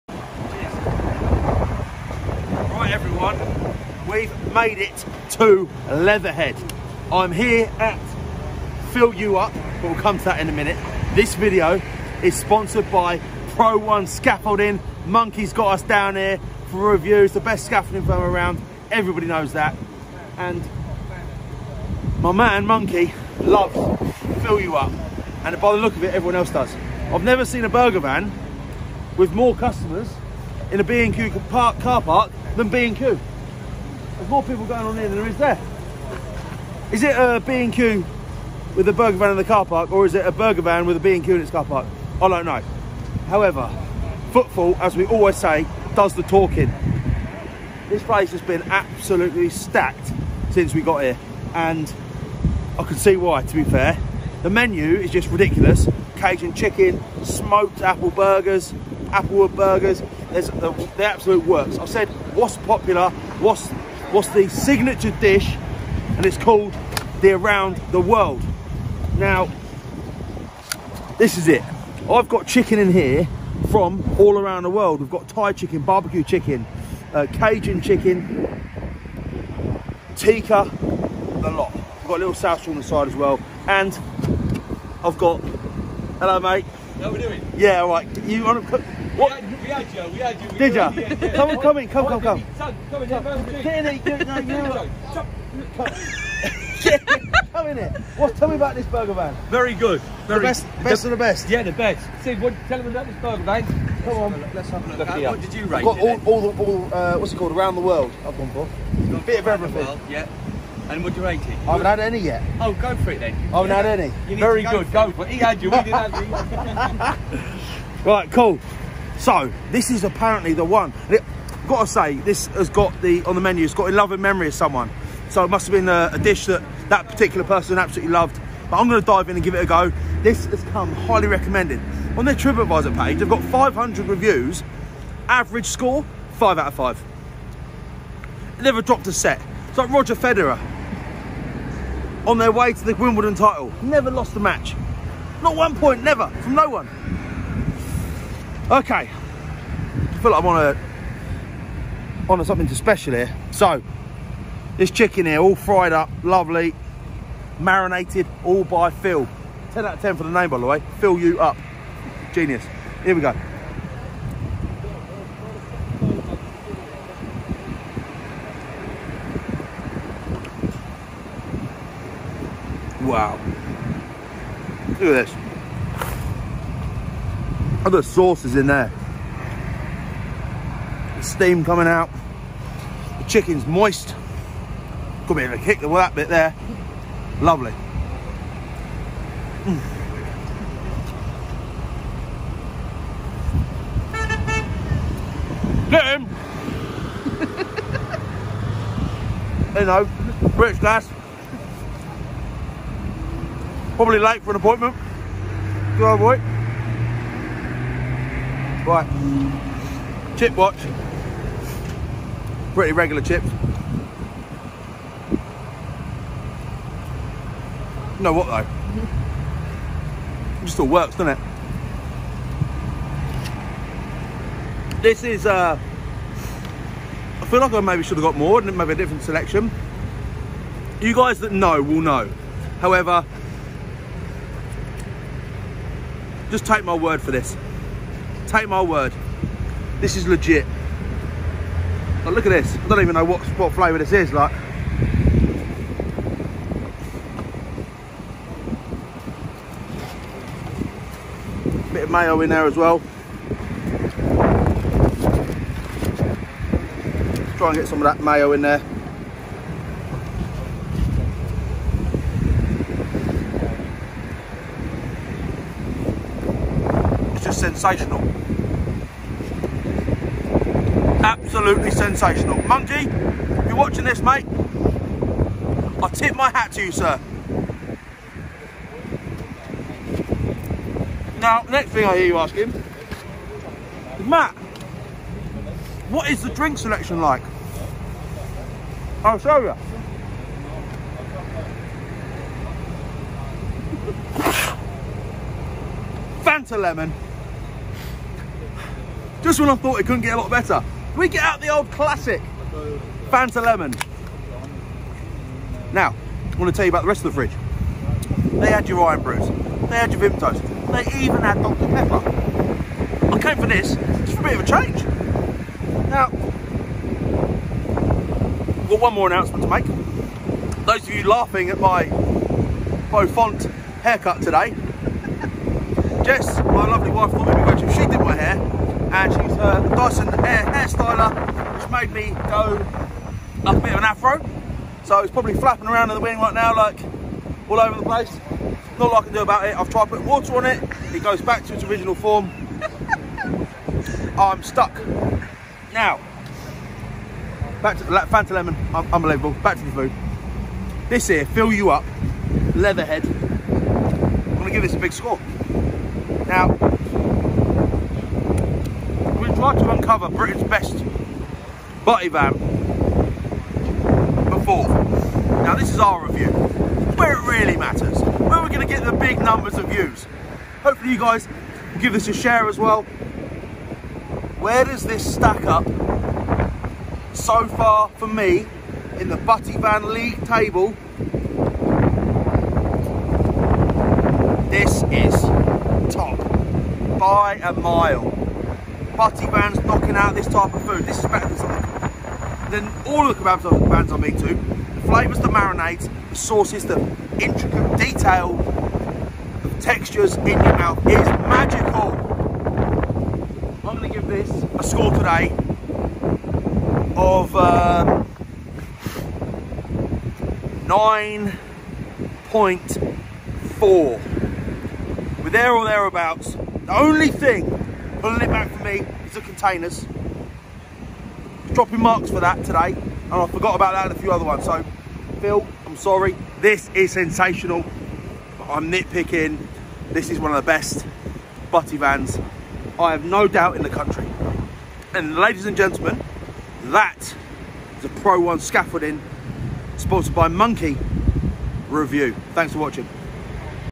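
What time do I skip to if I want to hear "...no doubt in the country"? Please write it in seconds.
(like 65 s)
433 s.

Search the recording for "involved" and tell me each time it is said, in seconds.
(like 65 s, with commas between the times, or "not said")
not said.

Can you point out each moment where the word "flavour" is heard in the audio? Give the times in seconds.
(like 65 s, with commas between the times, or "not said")
243 s, 395 s.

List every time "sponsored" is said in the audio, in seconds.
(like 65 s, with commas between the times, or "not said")
12 s, 439 s.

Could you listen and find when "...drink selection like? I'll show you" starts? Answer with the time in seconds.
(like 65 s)
286 s.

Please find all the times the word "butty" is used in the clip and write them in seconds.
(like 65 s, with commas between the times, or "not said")
362 s, 379 s, 389 s, 431 s.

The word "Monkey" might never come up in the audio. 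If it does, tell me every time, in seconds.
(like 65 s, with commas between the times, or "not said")
15 s, 22 s, 272 s, 440 s.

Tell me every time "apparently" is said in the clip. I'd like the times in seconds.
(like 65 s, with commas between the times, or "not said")
120 s.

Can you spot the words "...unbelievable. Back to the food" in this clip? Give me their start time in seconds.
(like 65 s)
349 s.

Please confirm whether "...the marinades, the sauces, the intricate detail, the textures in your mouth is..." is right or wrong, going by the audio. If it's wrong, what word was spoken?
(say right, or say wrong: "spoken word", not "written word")
right.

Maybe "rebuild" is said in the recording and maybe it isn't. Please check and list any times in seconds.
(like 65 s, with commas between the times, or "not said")
not said.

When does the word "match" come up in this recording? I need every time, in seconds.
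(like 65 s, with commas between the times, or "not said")
144 s.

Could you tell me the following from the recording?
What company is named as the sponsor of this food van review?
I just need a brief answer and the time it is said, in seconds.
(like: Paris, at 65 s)
Pro One Scaffolding, at 13 s.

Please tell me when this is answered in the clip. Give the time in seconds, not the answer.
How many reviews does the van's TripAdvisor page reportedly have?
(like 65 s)
133 s.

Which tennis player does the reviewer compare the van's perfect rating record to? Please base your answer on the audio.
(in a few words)
Roger Federer.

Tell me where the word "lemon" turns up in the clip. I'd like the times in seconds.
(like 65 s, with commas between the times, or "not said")
296 s, 303 s, 348 s.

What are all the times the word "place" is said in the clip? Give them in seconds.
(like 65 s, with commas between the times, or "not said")
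48 s, 338 s.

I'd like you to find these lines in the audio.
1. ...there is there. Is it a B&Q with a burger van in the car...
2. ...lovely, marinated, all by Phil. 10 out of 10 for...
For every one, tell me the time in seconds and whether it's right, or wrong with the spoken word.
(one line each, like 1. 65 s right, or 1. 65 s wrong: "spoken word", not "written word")
1. 35 s right
2. 156 s right.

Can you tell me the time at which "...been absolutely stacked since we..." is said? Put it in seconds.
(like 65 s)
48 s.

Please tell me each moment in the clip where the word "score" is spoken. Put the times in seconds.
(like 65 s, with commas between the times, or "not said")
135 s, 355 s, 404 s.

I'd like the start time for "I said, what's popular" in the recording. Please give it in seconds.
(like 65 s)
61 s.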